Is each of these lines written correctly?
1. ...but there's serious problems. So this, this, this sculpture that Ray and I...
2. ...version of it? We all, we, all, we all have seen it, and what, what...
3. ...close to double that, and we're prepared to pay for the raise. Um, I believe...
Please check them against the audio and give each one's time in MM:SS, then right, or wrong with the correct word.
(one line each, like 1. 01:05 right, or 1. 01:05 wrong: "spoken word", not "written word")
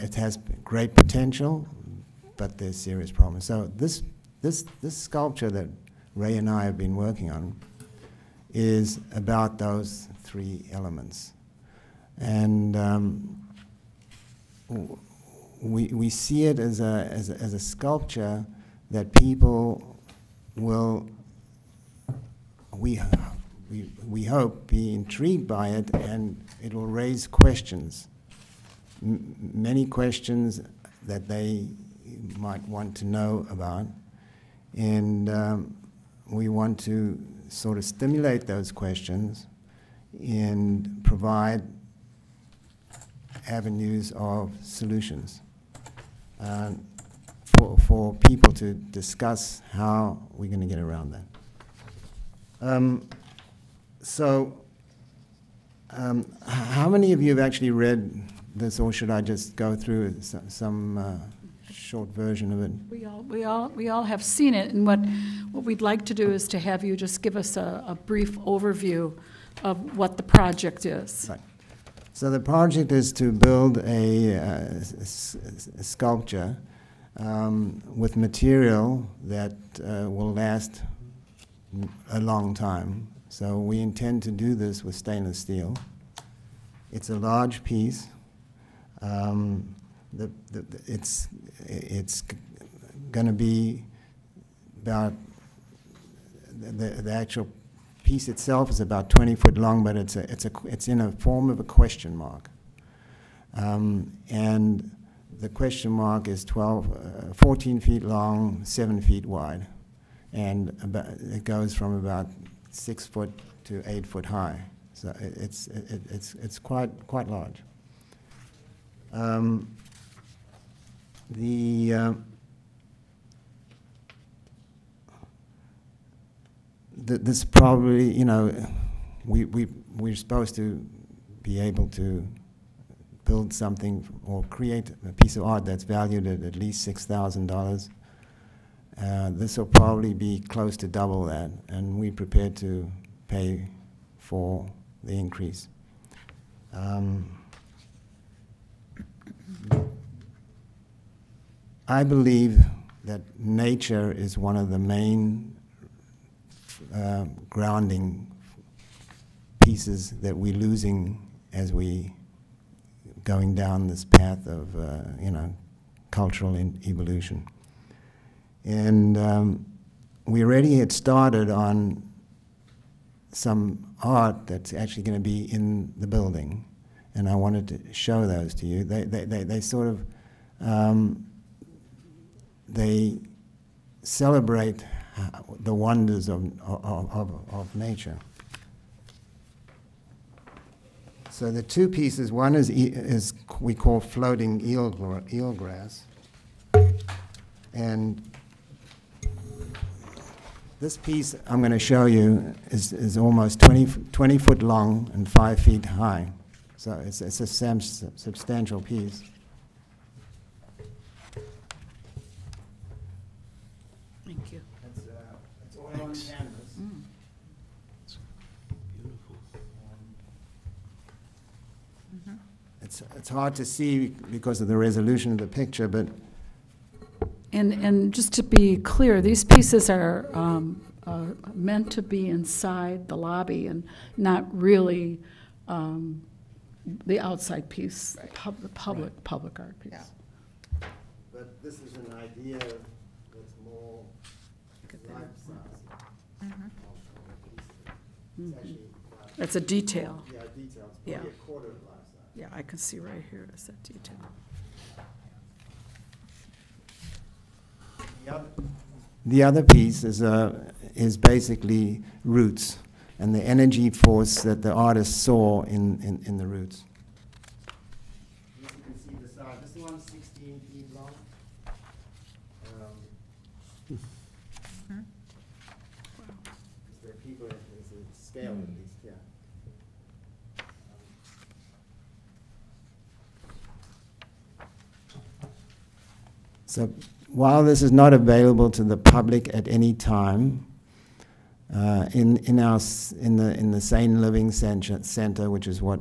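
1. 00:02 right
2. 01:02 right
3. 02:20 wrong: "increase", not "raise".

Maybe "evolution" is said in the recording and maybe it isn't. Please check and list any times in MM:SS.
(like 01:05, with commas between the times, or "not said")
02:46.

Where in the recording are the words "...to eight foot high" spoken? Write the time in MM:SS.
01:53.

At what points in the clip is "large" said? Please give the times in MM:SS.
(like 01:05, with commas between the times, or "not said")
01:27, 01:57.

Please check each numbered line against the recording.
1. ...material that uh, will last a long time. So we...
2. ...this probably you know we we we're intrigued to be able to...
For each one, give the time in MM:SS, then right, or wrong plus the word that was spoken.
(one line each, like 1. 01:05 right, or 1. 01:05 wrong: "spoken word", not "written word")
1. 01:18 right
2. 02:07 wrong: "supposed", not "intrigued".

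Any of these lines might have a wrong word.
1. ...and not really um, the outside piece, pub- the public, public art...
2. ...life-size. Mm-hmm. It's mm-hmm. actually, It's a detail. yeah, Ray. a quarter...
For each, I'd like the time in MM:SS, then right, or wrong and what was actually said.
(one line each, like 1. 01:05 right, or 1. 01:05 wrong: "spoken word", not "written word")
1. 03:53 right
2. 04:05 wrong: "Yeah", not "Ray".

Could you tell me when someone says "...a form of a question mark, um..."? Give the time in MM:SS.
01:41.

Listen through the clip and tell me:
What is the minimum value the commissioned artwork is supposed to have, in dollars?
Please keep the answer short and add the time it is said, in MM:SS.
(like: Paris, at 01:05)
$6,000, at 02:16.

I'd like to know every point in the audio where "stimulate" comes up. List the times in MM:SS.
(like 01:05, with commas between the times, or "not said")
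00:37.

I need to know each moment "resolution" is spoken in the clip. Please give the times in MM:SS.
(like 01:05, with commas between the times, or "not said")
03:44.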